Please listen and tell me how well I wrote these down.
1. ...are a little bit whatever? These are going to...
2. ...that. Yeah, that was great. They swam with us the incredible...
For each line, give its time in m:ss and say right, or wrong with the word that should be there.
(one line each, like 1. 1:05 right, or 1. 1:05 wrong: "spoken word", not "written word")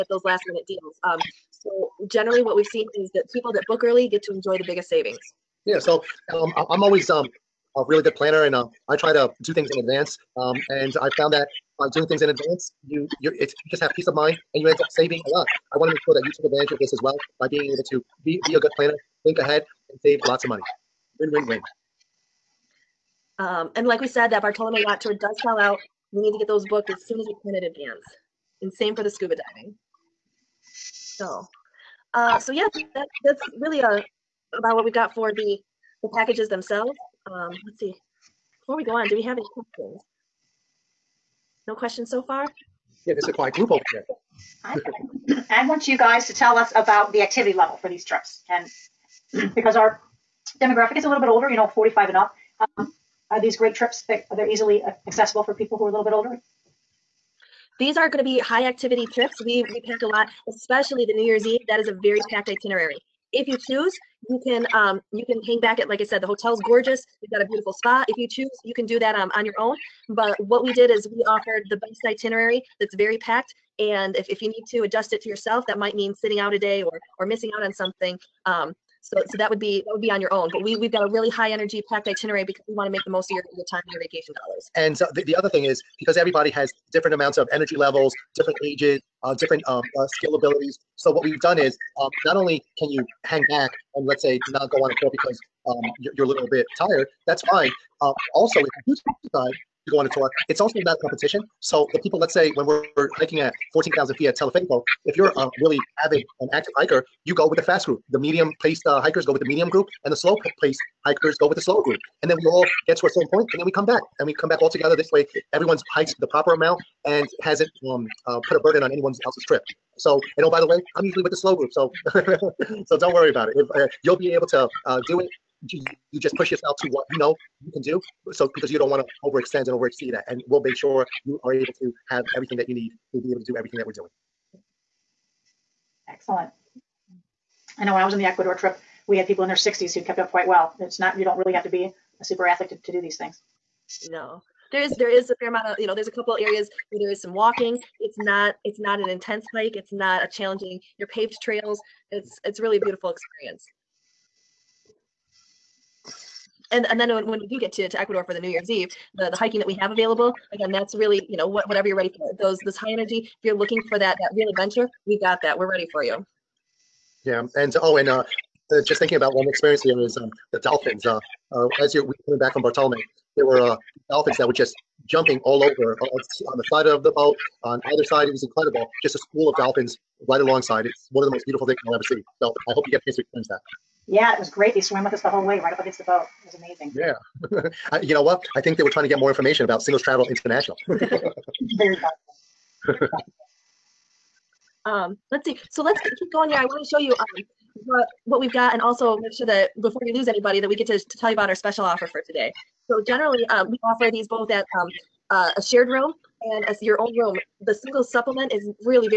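1. 0:55 wrong: "older", not "whatever"
2. 3:03 wrong: "whole", not "incredible".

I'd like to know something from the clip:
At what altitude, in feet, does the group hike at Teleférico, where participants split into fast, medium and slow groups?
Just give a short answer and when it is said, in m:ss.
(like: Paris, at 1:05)
14,000 feet, at 1:43.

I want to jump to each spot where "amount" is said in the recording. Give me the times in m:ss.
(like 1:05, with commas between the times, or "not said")
1:27, 1:56, 2:25.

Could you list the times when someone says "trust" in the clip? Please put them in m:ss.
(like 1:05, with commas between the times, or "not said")
not said.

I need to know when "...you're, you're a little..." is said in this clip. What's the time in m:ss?
1:35.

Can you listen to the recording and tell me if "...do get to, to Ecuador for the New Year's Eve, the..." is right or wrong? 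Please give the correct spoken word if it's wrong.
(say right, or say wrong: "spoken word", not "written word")
right.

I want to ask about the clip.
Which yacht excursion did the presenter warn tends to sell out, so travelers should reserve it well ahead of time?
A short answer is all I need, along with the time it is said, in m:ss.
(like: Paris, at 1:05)
Bartolome Yacht Tour, at 0:24.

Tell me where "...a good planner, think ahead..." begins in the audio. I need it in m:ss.
0:18.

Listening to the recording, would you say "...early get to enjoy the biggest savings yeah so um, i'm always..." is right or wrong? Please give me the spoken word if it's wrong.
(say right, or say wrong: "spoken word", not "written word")
right.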